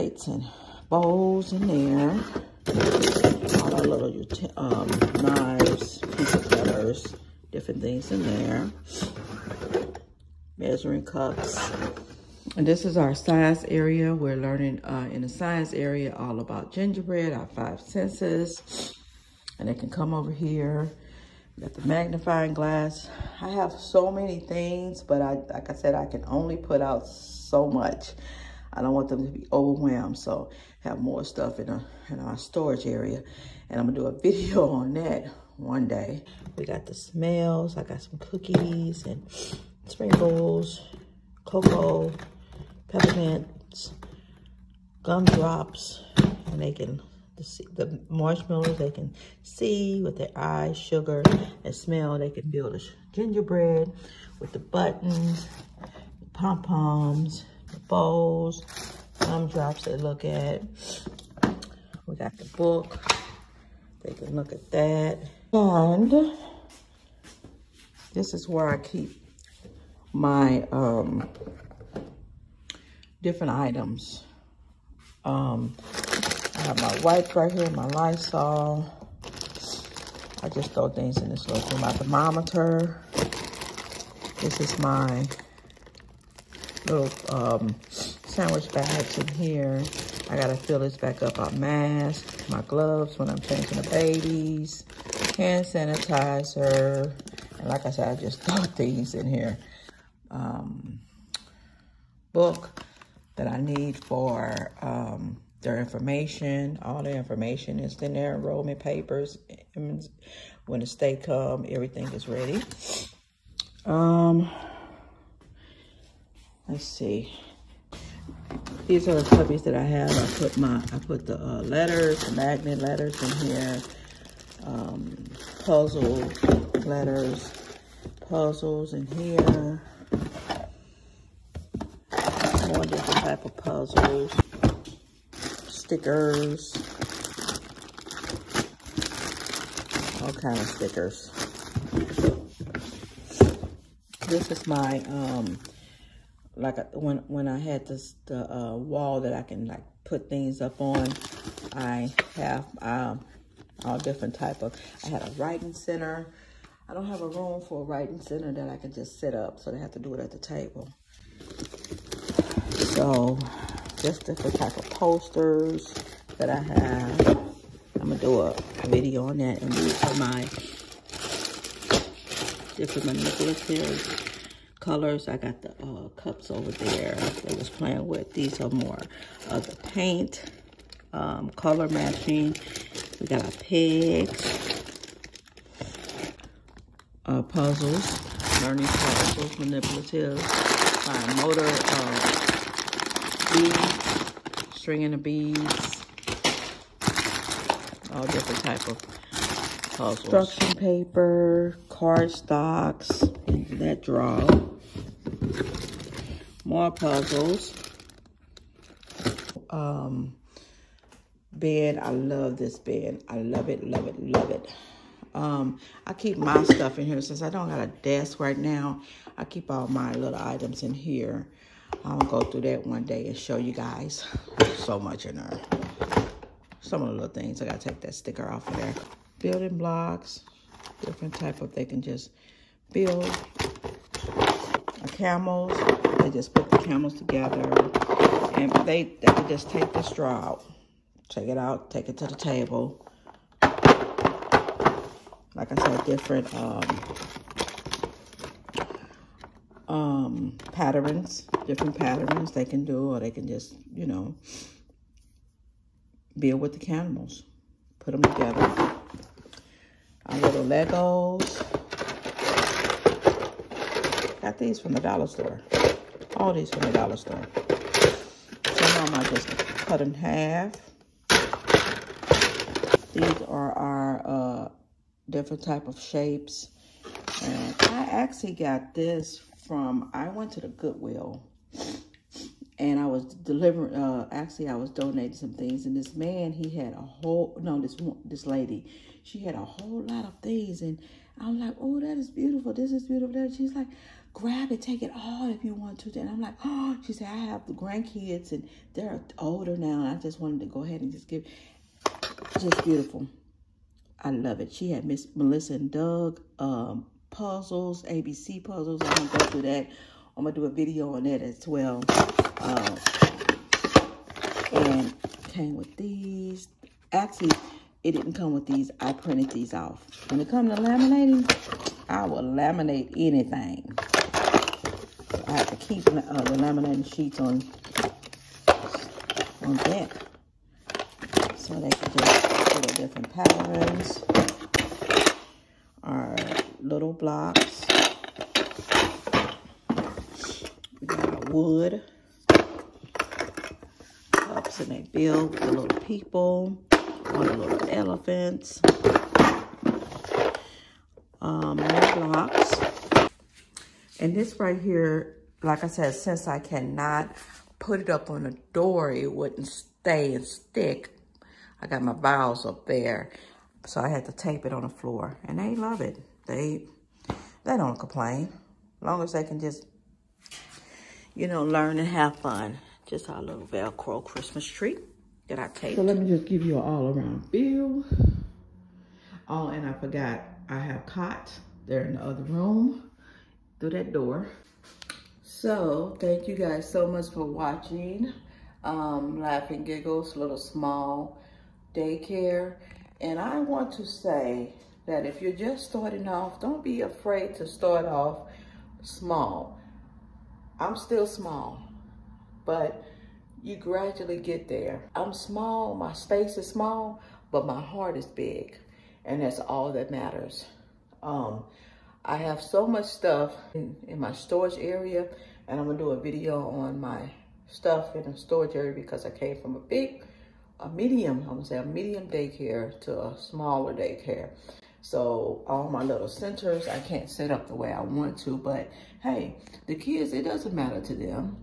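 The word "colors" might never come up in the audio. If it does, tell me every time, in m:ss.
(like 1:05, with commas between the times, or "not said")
2:54, 3:01.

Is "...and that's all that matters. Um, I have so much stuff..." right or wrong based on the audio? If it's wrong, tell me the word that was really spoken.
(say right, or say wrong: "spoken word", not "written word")
right.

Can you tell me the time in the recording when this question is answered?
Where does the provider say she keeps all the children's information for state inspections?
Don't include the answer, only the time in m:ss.
1:48.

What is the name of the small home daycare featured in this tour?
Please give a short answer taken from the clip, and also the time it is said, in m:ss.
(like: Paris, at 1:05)
LaughNGiggles, at 6:29.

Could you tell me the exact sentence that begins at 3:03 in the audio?
We got our pigs, our uh, puzzles, learning puzzles, manipulatives, motor uh, beads, stringing of beads, all different type of puzzles.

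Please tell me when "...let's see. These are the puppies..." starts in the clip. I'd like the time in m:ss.
1:56.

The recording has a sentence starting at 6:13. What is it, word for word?
Just our little Velcro Christmas tree that I take.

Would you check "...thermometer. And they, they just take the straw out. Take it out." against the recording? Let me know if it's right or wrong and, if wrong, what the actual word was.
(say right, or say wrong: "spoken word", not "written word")
wrong: "together", not "thermometer".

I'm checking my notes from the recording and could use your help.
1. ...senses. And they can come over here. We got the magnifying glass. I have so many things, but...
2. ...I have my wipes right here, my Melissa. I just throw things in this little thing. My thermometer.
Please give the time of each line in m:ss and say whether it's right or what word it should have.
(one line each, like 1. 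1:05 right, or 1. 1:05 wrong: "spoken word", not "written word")
1. 0:17 right
2. 1:16 wrong: "Lysol", not "Melissa".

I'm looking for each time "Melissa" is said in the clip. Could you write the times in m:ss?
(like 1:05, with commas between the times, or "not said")
5:05.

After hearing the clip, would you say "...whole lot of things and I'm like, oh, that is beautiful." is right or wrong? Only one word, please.
right.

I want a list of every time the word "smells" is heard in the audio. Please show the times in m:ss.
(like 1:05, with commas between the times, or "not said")
0:36, 0:51.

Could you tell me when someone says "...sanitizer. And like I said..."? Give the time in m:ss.
1:35.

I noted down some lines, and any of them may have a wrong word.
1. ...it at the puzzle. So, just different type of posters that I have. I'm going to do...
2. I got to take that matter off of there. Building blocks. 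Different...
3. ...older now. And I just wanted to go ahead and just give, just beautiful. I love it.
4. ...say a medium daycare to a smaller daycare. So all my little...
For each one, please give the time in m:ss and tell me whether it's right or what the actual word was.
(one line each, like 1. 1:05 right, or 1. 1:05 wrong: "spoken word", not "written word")
1. 2:40 wrong: "table", not "puzzle"
2. 3:47 wrong: "sticker", not "matter"
3. 4:59 right
4. 7:01 right.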